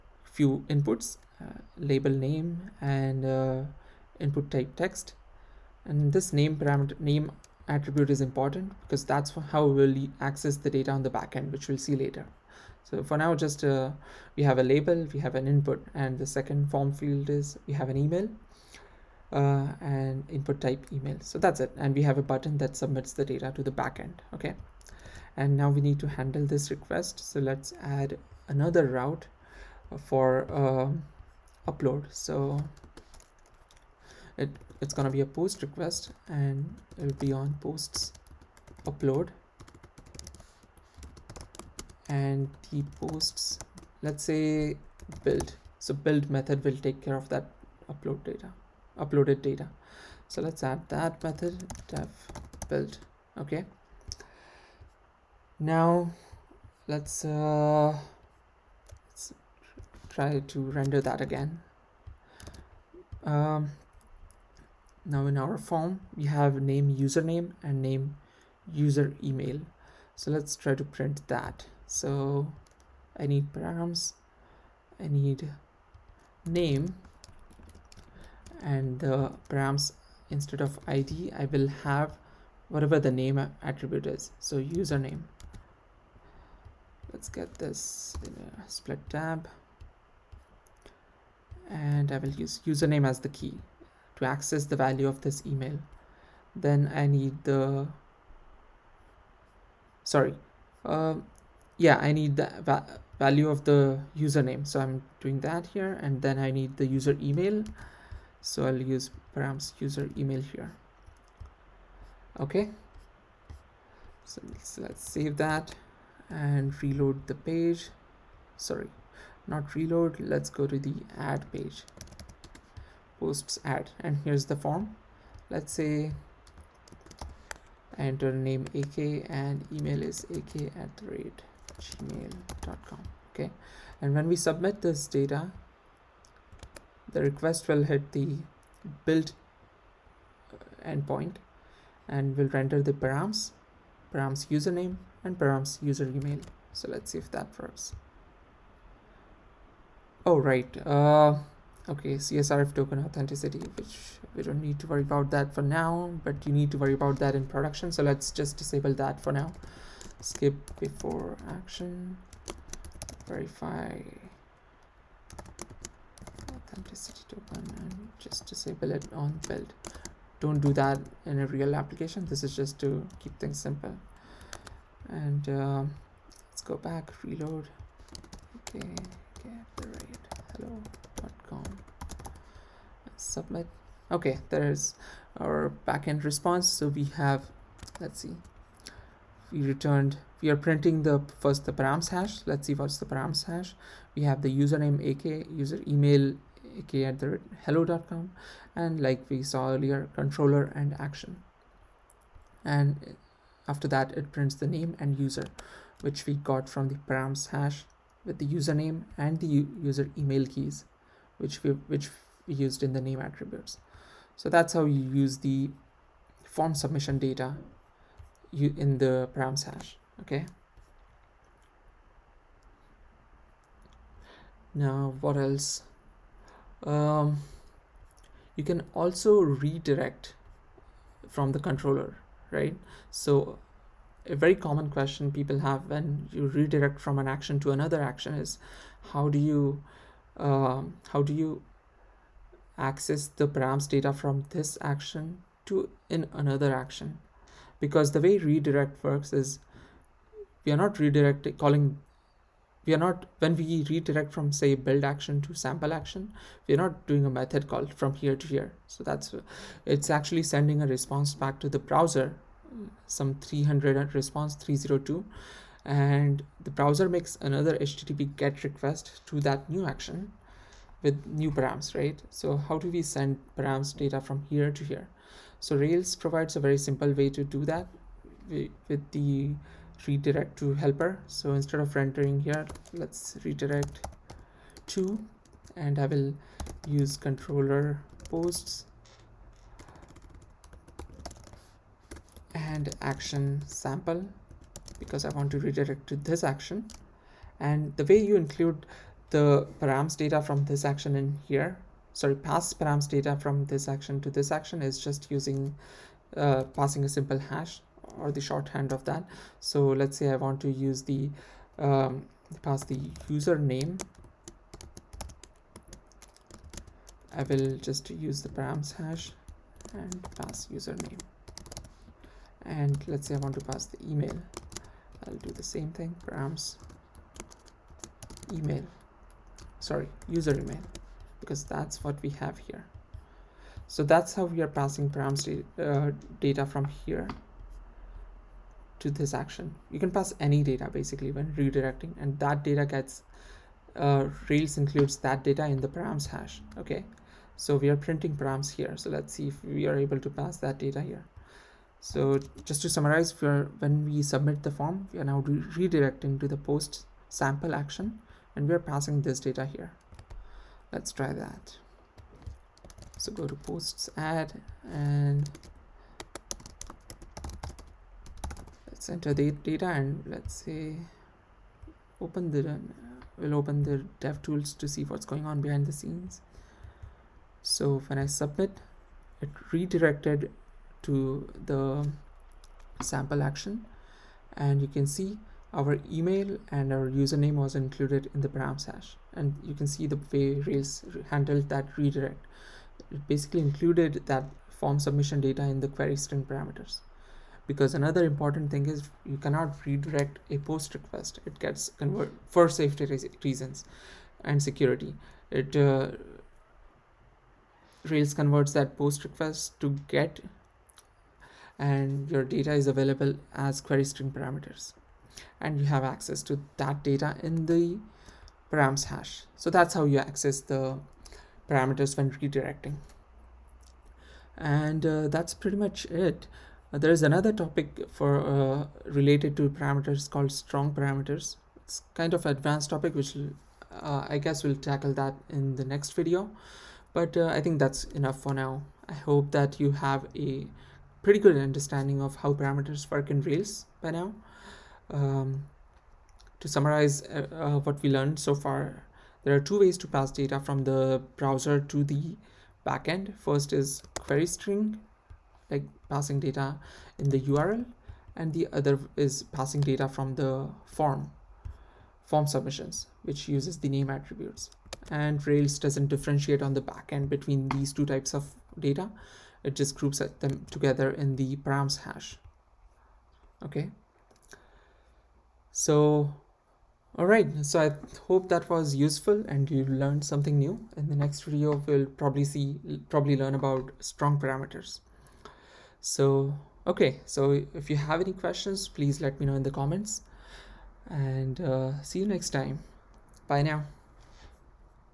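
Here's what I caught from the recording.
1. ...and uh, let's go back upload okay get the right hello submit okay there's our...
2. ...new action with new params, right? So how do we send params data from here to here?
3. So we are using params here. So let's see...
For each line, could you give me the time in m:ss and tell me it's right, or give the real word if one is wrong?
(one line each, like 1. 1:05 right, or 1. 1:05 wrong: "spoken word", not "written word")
1. 2:55 wrong: "reload", not "upload"
2. 4:29 right
3. 5:47 wrong: "printing", not "using".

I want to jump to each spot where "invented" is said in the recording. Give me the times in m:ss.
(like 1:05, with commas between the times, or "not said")
not said.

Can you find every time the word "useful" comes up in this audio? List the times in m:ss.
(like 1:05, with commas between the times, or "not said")
7:58.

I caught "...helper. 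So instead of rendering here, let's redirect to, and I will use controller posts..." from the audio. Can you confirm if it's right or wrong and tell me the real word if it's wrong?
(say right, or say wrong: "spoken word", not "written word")
right.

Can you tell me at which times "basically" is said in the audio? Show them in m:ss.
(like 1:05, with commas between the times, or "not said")
5:40, 6:33.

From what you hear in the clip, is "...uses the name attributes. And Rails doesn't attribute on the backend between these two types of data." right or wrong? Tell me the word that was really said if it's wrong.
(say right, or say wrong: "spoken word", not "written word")
wrong: "differentiate", not "attribute".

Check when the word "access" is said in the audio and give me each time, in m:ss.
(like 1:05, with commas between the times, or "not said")
0:10, 1:34, 4:02, 6:56, 7:00.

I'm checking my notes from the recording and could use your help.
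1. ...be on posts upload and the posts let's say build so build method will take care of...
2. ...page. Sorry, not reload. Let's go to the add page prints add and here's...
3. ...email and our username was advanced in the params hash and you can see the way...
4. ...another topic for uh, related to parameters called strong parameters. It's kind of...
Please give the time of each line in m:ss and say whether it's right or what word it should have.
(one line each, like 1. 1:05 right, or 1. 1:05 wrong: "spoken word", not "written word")
1. 0:37 right
2. 1:57 wrong: "posts", not "prints"
3. 6:26 wrong: "included", not "advanced"
4. 7:07 right.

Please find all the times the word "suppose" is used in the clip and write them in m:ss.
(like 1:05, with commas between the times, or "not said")
not said.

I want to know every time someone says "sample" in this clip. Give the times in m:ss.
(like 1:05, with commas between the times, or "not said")
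4:15, 4:53, 5:57, 6:23.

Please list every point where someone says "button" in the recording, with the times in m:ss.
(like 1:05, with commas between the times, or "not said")
0:22.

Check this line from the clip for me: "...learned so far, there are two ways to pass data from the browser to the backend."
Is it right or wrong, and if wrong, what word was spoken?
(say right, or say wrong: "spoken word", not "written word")
right.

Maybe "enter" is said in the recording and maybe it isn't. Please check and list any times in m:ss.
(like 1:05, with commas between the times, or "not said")
2:07, 6:09.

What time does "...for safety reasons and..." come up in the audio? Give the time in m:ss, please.
6:42.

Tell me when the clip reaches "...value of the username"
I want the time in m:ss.
1:43.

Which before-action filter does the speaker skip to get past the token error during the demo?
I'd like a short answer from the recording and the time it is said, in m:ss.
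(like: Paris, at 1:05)
verify authenticity token, at 2:43.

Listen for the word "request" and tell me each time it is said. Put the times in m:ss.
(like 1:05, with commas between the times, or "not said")
0:26, 0:35, 2:17, 4:28, 6:40, 6:49.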